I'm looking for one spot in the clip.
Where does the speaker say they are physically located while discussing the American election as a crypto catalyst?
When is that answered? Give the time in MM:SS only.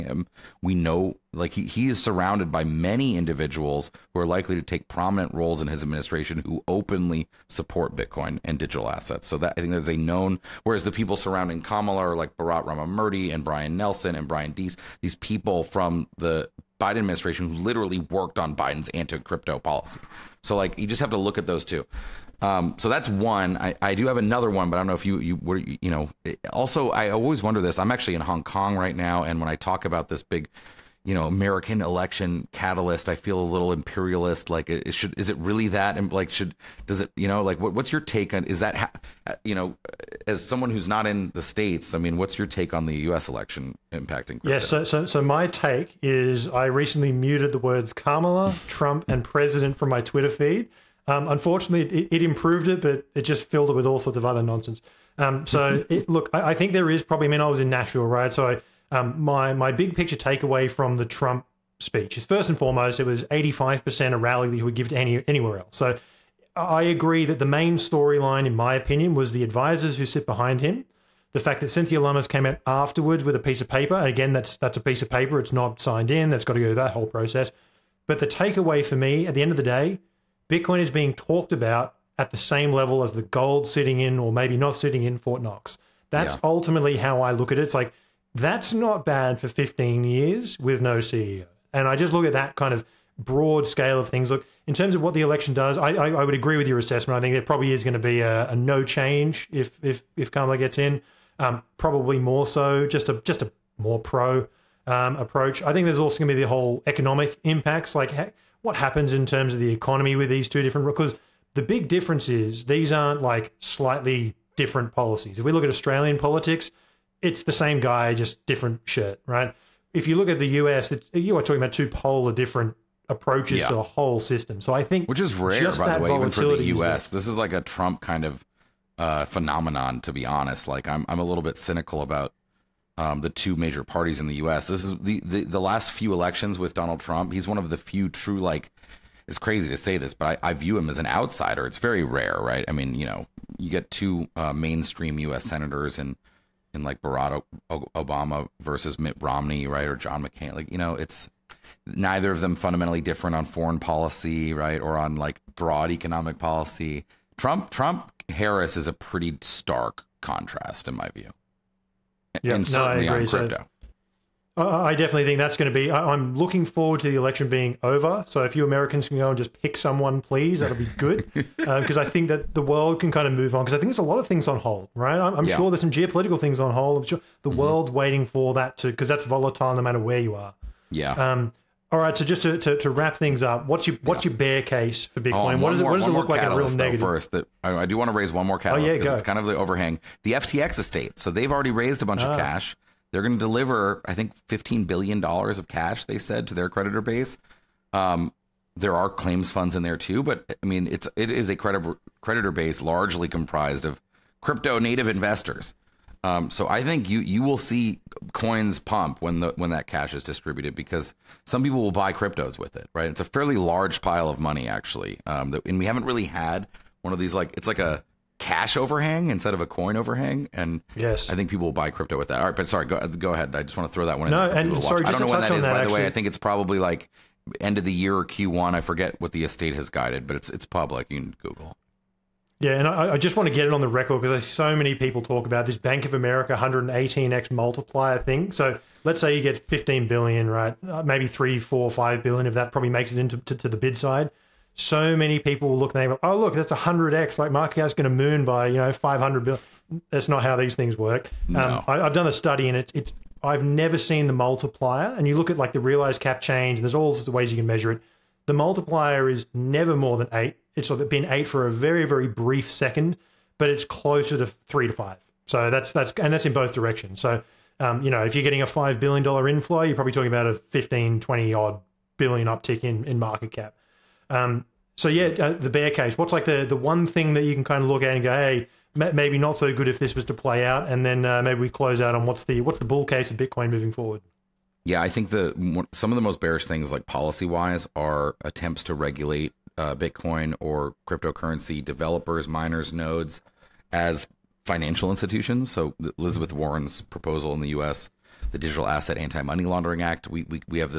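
00:28.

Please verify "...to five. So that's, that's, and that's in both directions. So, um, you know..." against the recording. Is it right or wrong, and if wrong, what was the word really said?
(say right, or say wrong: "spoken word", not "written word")
right.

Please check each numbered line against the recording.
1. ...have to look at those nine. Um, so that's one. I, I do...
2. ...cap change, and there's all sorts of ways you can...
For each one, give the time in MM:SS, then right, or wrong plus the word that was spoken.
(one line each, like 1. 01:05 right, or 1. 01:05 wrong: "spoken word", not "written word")
1. 00:21 wrong: "two", not "nine"
2. 04:16 right.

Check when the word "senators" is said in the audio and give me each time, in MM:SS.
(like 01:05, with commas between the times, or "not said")
02:25.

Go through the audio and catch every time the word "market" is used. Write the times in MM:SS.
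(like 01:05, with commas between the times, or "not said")
04:07, 04:33.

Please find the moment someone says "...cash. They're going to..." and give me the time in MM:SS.
03:12.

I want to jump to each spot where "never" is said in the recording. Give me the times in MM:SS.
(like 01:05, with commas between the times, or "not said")
04:13, 04:19.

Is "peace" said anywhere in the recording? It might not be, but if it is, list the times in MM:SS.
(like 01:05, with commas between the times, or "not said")
not said.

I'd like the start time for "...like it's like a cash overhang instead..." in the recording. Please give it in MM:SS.
03:37.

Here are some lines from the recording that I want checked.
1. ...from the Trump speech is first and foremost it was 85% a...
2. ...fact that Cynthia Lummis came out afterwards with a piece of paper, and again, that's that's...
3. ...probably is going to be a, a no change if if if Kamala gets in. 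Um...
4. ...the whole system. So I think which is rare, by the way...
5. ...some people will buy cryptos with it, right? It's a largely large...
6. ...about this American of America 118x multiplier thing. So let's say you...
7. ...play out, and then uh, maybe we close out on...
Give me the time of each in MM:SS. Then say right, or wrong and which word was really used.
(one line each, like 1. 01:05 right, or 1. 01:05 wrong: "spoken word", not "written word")
1. 01:00 right
2. 01:11 right
3. 01:37 right
4. 02:03 right
5. 03:31 wrong: "fairly", not "largely"
6. 03:55 wrong: "Bank", not "American"
7. 04:40 right.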